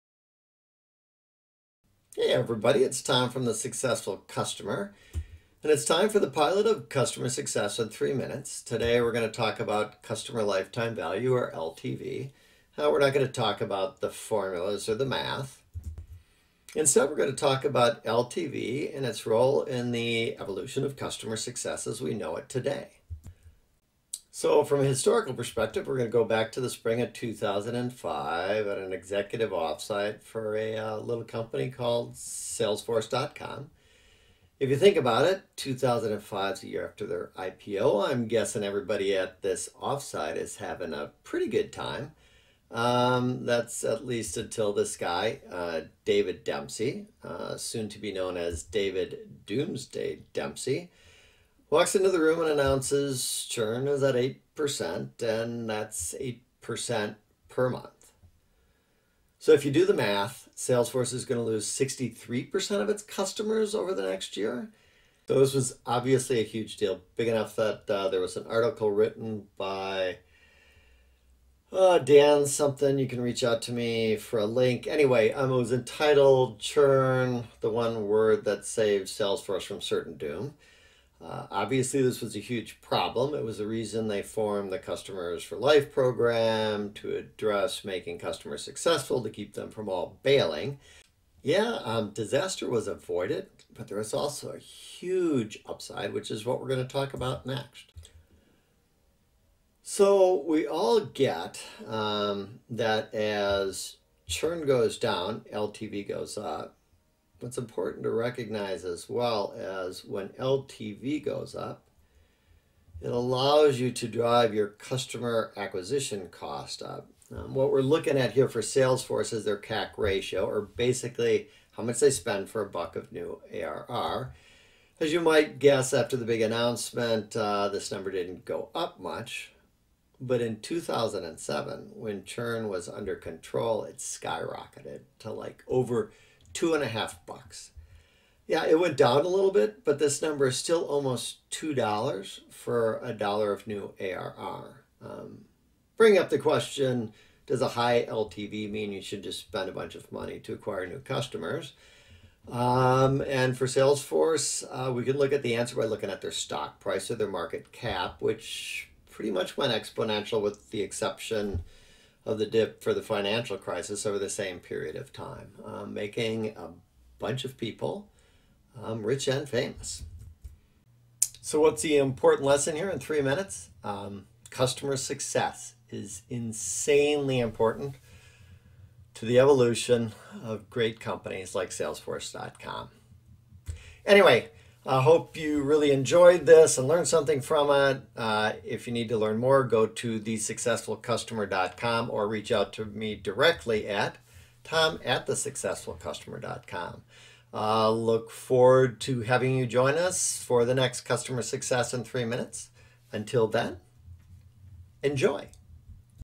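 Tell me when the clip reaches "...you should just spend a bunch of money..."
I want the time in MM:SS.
02:28.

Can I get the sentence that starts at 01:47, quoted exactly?
What's important to recognize as well as when LTV goes up, it allows you to drive your customer acquisition cost up.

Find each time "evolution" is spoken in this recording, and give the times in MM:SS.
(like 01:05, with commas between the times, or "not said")
00:20, 02:59.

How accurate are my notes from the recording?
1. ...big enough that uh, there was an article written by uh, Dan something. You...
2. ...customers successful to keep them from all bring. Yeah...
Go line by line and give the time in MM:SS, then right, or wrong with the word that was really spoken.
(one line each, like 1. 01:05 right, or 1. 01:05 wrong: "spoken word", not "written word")
1. 01:07 right
2. 01:28 wrong: "bailing", not "bring".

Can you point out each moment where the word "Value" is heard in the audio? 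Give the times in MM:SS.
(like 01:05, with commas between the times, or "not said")
00:10.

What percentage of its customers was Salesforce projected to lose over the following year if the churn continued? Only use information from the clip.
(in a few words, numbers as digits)
63%.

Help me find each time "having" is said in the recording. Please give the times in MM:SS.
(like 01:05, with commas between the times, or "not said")
00:40, 03:19.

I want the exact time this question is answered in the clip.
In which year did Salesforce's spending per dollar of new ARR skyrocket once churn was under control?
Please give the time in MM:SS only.
02:10.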